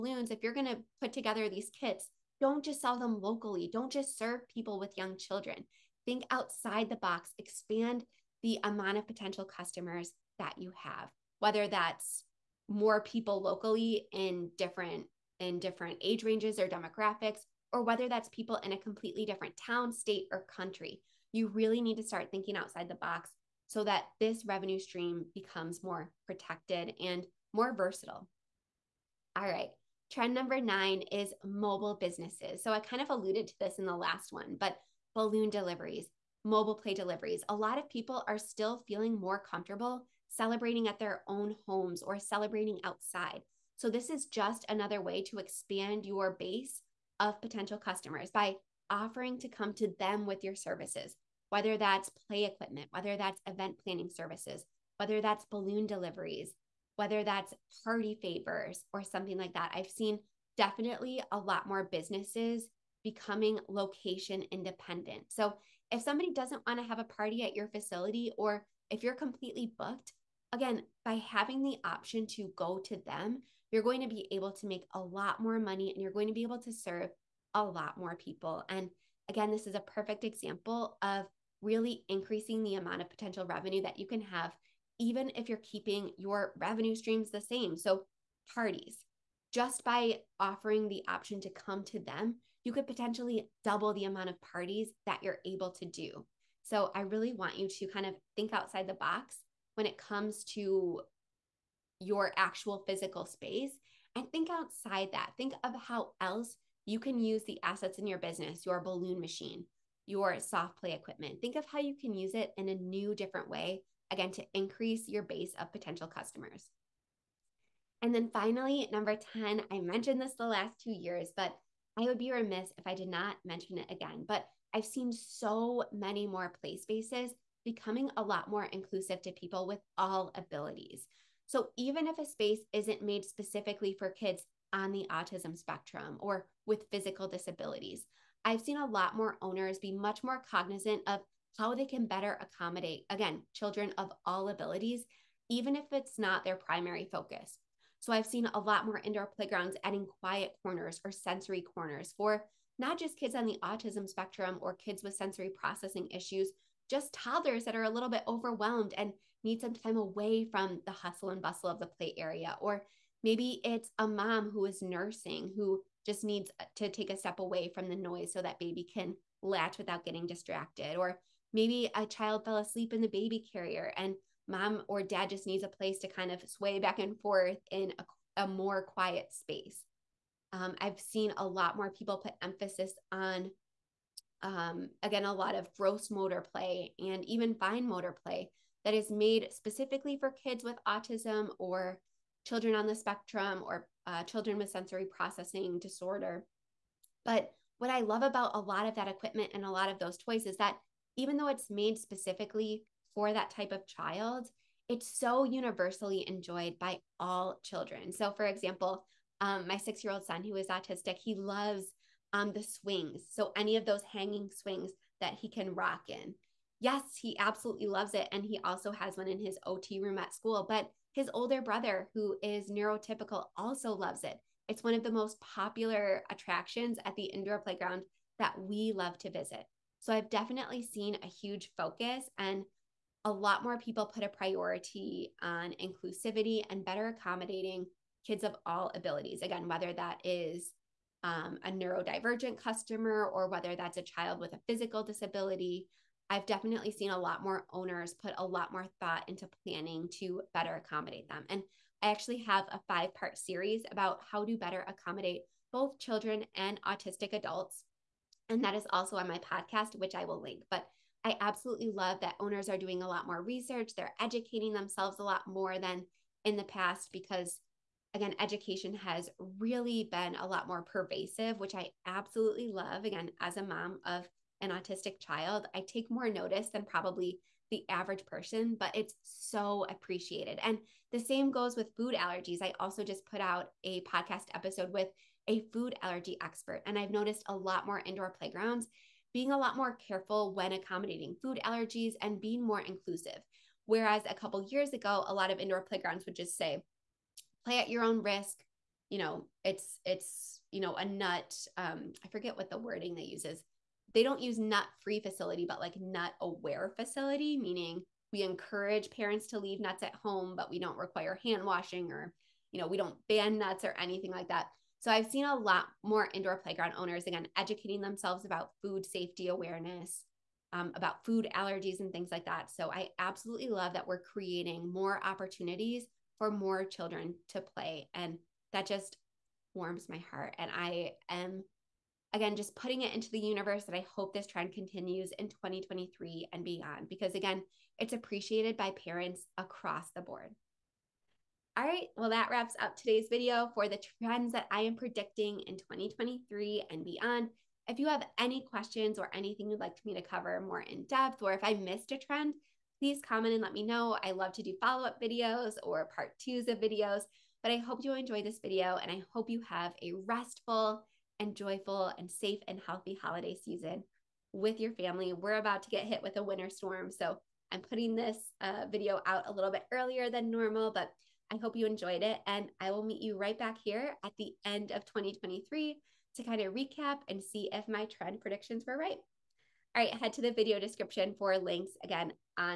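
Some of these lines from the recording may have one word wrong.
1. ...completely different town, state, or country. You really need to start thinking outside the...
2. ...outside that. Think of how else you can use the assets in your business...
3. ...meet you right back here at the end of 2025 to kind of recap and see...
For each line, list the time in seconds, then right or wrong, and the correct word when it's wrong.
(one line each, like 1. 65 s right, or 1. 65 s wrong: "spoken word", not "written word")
1. 18 s right
2. 104 s right
3. 373 s wrong: "2023", not "2025".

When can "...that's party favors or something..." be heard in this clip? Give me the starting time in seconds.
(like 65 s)
57 s.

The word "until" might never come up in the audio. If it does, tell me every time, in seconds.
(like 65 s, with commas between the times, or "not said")
not said.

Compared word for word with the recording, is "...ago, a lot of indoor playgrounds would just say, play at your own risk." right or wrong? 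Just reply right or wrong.
right.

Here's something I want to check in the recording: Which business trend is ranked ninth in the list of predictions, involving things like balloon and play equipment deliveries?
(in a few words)
Mobile businesses.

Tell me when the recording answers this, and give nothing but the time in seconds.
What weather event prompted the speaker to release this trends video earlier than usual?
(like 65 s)
366 s.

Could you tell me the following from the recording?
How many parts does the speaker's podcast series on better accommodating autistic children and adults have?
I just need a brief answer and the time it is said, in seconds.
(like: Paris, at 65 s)
5, at 252 s.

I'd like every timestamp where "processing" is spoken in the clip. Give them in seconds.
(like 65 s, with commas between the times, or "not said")
155 s, 195 s.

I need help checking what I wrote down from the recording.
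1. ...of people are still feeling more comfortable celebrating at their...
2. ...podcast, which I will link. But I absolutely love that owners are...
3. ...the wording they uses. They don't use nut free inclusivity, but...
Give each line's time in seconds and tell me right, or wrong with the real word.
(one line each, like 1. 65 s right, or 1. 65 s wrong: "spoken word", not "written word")
1. 37 s right
2. 259 s right
3. 302 s wrong: "facility", not "inclusivity".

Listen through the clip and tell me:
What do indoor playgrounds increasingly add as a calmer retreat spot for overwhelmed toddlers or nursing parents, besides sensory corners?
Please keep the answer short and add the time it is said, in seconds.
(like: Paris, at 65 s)
Quiet corners, at 150 s.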